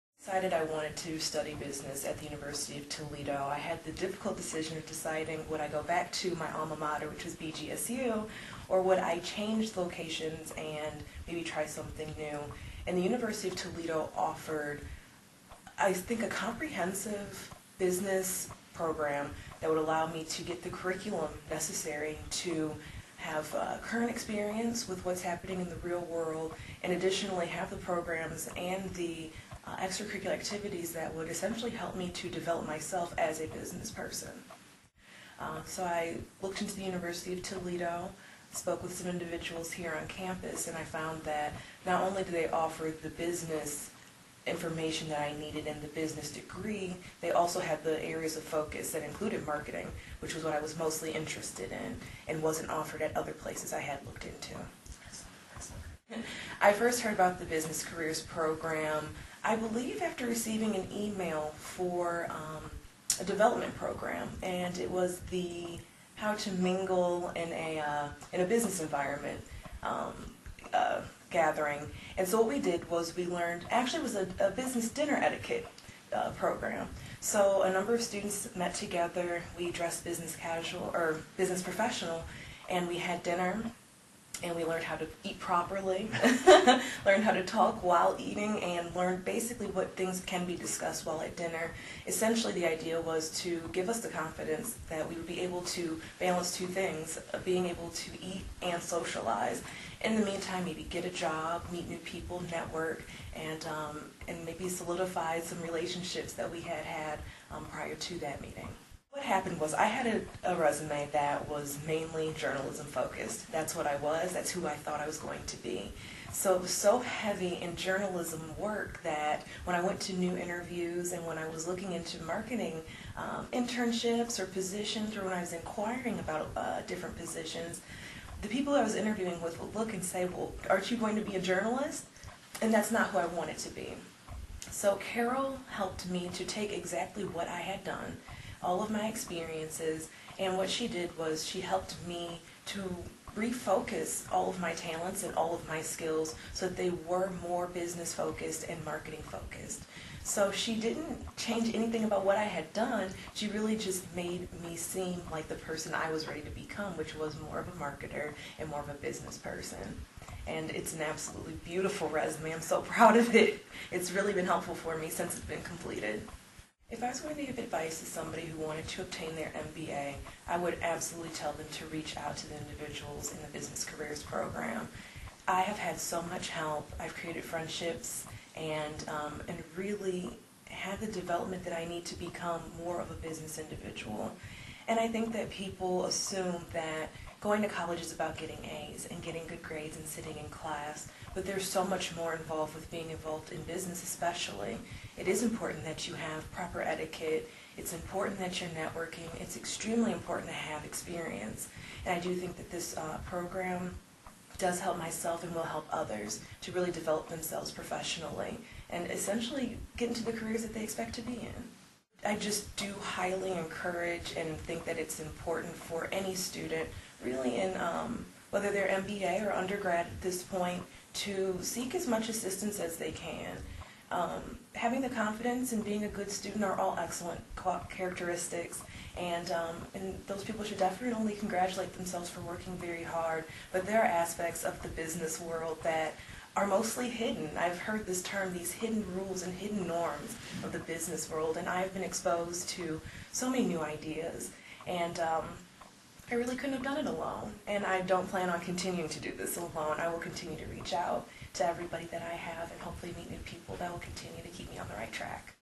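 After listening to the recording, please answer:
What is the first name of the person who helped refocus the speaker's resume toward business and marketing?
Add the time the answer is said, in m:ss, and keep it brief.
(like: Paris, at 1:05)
Carol, at 2:14.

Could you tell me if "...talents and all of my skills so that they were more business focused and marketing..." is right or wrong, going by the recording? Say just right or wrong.
right.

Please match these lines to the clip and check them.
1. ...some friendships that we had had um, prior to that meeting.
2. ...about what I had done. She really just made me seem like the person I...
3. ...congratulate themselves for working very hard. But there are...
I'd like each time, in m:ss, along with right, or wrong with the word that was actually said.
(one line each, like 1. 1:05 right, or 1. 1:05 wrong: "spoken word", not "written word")
1. 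1:45 wrong: "relationships", not "friendships"
2. 2:32 right
3. 3:51 right.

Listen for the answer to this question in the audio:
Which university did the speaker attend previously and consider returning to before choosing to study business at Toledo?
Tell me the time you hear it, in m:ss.
0:07.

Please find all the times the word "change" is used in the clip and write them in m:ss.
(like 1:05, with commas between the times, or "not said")
0:09, 2:31.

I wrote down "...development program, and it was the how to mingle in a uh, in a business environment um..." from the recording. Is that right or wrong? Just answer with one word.
right.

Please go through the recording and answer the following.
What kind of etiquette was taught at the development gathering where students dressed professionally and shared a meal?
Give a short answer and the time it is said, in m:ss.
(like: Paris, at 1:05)
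business dinner etiquette, at 1:14.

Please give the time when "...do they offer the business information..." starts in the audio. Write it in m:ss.
0:42.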